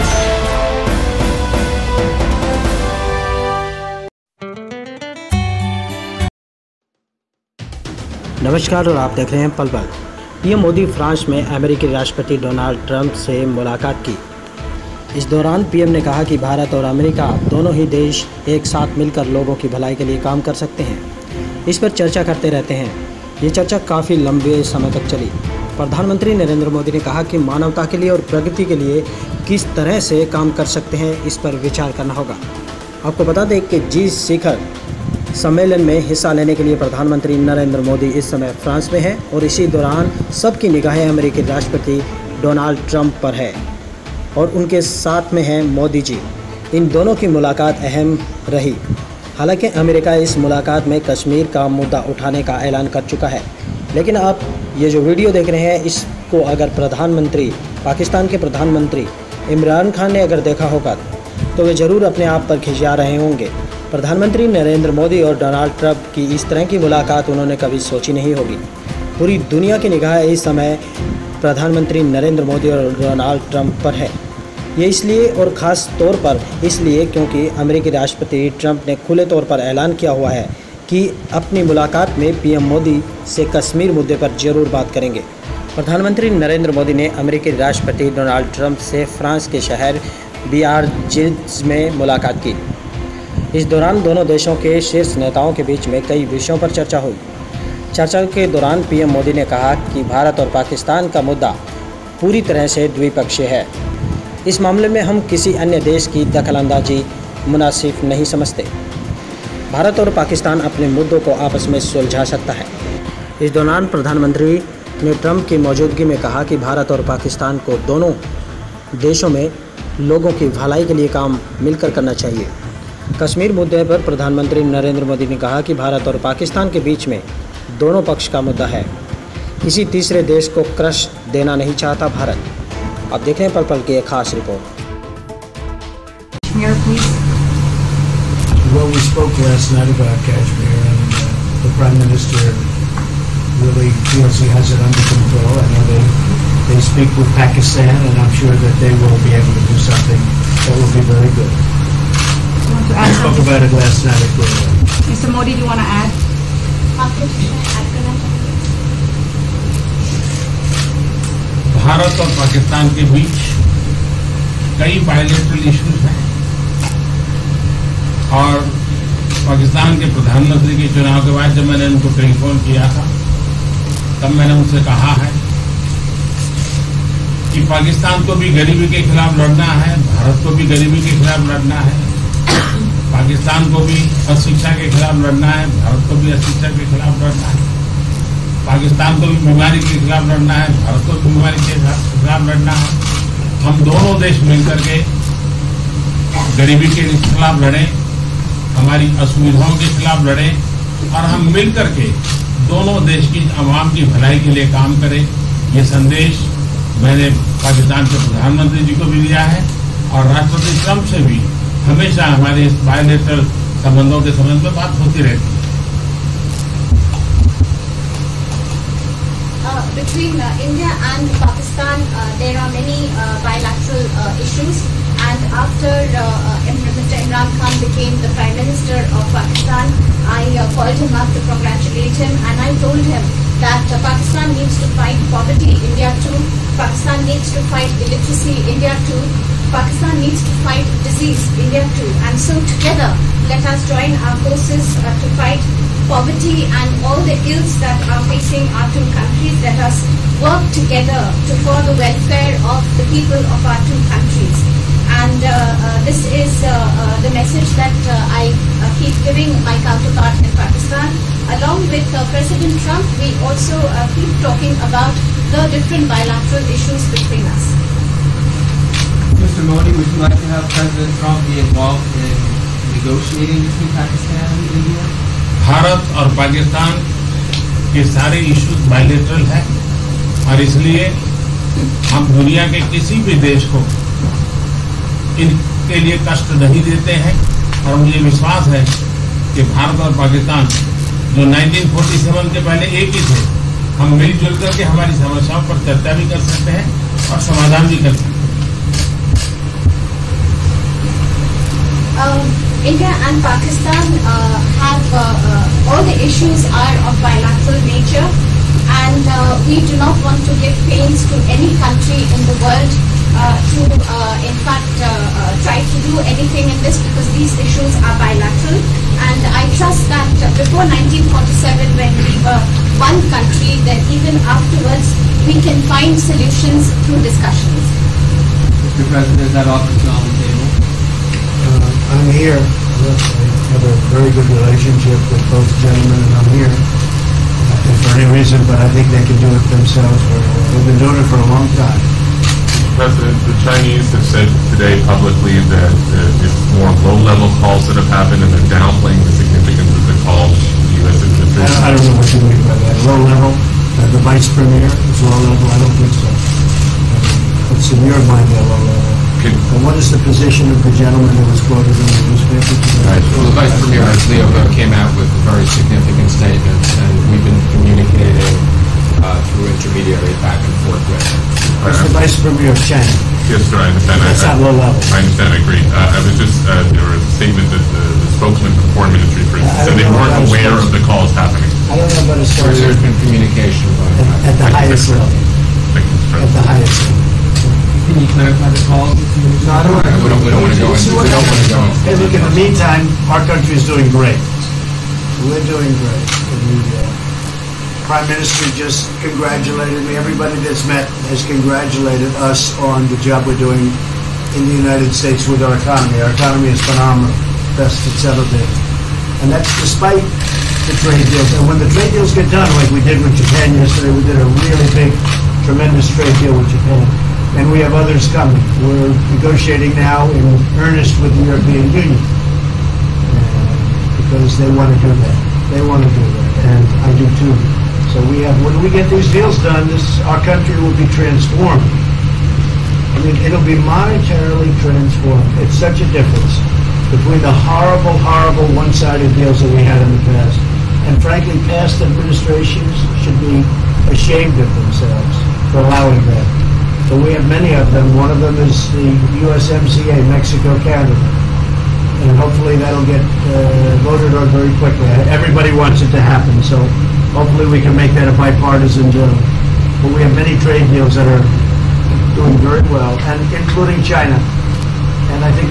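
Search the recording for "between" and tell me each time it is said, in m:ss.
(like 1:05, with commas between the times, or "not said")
3:39, 4:27, 4:33, 7:17.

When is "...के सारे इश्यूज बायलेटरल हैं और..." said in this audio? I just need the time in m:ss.
4:37.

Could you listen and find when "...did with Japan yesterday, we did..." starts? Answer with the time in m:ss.
6:53.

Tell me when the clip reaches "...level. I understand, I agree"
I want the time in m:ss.
6:14.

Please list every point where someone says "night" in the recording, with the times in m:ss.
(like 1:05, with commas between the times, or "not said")
2:19, 2:34.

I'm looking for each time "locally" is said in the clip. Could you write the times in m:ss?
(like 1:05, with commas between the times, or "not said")
not said.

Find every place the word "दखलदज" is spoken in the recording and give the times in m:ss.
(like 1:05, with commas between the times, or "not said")
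1:46.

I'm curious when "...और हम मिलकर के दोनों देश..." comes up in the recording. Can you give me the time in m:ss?
3:21.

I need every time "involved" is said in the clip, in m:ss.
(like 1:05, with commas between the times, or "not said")
4:31.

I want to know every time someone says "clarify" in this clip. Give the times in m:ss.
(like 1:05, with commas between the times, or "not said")
6:28.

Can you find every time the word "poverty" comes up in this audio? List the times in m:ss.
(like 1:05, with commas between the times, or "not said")
3:55, 4:06.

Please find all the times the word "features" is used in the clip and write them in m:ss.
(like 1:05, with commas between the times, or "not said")
not said.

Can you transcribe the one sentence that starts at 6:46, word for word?
Our economy is phenomenal, best it's ever been.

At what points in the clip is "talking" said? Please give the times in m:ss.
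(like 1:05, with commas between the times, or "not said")
4:24.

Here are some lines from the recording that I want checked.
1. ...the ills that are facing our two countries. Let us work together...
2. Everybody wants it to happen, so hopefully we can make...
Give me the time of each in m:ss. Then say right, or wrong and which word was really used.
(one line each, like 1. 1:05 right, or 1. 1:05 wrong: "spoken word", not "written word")
1. 4:07 right
2. 7:35 right.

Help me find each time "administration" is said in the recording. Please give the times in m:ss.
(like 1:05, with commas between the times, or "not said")
5:51, 7:21.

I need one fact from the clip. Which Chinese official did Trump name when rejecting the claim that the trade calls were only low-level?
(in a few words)
Vice Premier Liu.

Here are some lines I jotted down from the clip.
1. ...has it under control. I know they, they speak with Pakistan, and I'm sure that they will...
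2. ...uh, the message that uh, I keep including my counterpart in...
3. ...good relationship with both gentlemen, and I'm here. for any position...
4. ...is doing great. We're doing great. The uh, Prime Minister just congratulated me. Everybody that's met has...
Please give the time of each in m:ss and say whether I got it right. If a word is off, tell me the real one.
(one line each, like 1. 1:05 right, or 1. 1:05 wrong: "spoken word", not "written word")
1. 2:24 right
2. 4:16 wrong: "giving", not "including"
3. 5:34 wrong: "reason", not "position"
4. 6:33 right.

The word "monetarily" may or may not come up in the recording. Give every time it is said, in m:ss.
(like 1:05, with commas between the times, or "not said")
7:13.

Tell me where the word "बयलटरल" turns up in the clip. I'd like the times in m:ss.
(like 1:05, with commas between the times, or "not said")
2:45, 3:32, 4:38.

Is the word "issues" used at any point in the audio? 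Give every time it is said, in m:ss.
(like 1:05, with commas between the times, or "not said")
3:44, 4:26, 5:06, 5:17.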